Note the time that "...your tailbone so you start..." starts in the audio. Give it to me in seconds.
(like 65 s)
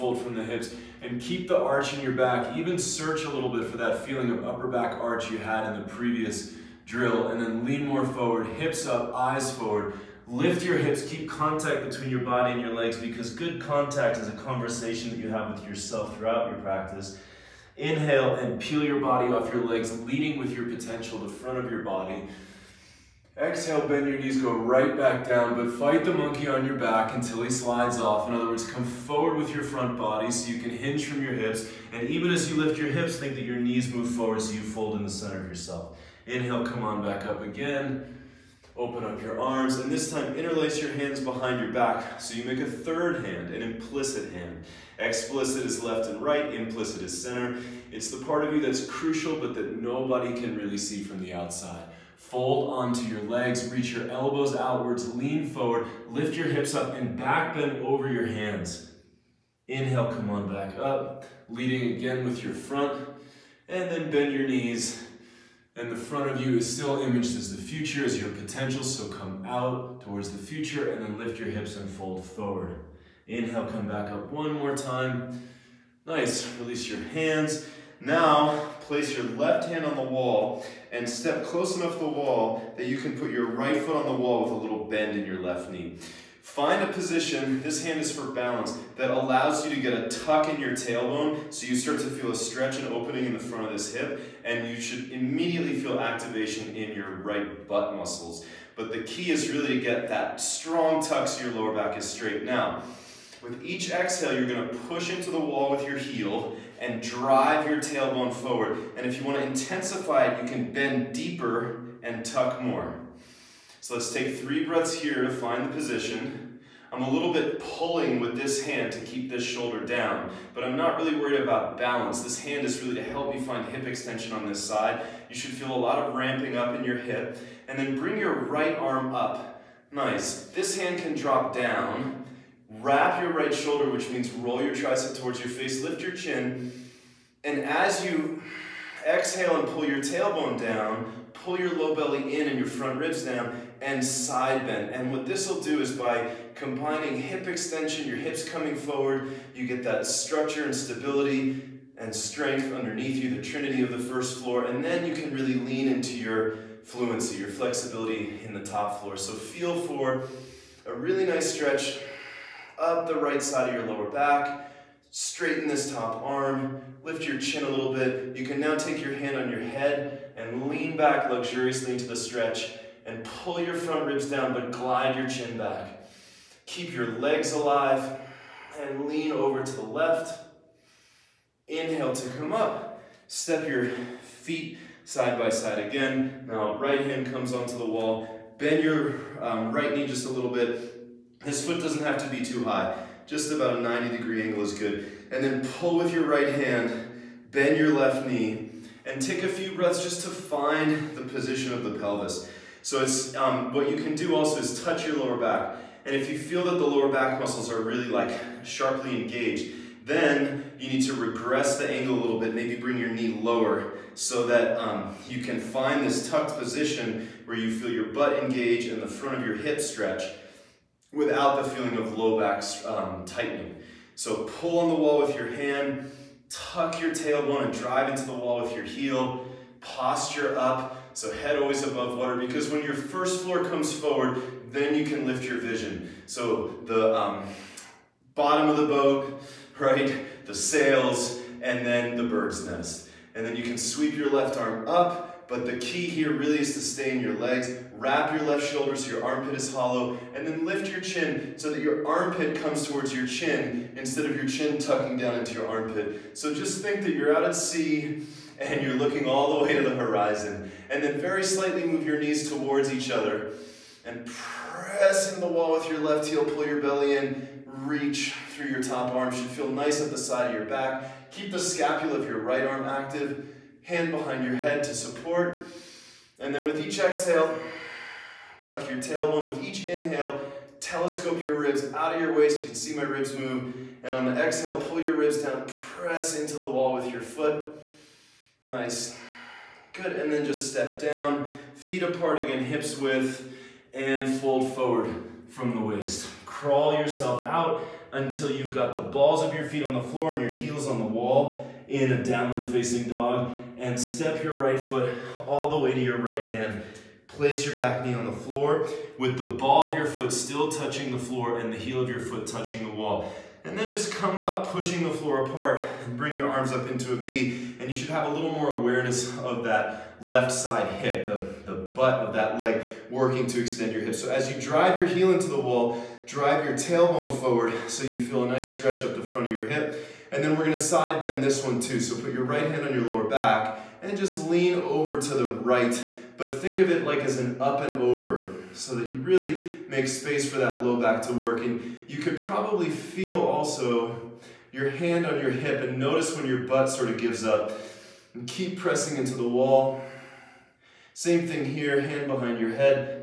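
90 s.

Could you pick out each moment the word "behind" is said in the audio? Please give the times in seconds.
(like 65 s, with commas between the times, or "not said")
41 s, 274 s, 352 s.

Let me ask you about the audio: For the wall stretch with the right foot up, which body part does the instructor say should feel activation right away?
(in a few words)
right butt muscles.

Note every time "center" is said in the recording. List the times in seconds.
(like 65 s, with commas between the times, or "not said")
35 s, 47 s.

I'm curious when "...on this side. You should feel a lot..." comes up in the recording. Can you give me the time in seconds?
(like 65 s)
124 s.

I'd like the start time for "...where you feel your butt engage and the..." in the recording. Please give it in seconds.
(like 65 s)
217 s.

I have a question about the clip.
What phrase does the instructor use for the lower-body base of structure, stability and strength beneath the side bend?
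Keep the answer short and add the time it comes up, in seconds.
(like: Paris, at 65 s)
the trinity of the first floor, at 153 s.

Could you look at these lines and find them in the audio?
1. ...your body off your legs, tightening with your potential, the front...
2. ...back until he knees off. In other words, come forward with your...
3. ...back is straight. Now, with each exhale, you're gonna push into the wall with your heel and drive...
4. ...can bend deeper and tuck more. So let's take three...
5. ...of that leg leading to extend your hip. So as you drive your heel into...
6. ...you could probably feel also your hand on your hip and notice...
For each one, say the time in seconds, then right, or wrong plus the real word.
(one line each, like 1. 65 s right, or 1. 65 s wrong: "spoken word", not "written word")
1. 18 s wrong: "leading", not "tightening"
2. 26 s wrong: "slides", not "knees"
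3. 101 s right
4. 110 s right
5. 322 s wrong: "working", not "leading"
6. 342 s right.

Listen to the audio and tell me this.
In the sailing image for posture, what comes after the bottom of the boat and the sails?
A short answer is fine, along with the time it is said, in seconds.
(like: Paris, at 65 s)
the bird's nest, at 242 s.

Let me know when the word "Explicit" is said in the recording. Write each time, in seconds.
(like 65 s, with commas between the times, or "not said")
44 s.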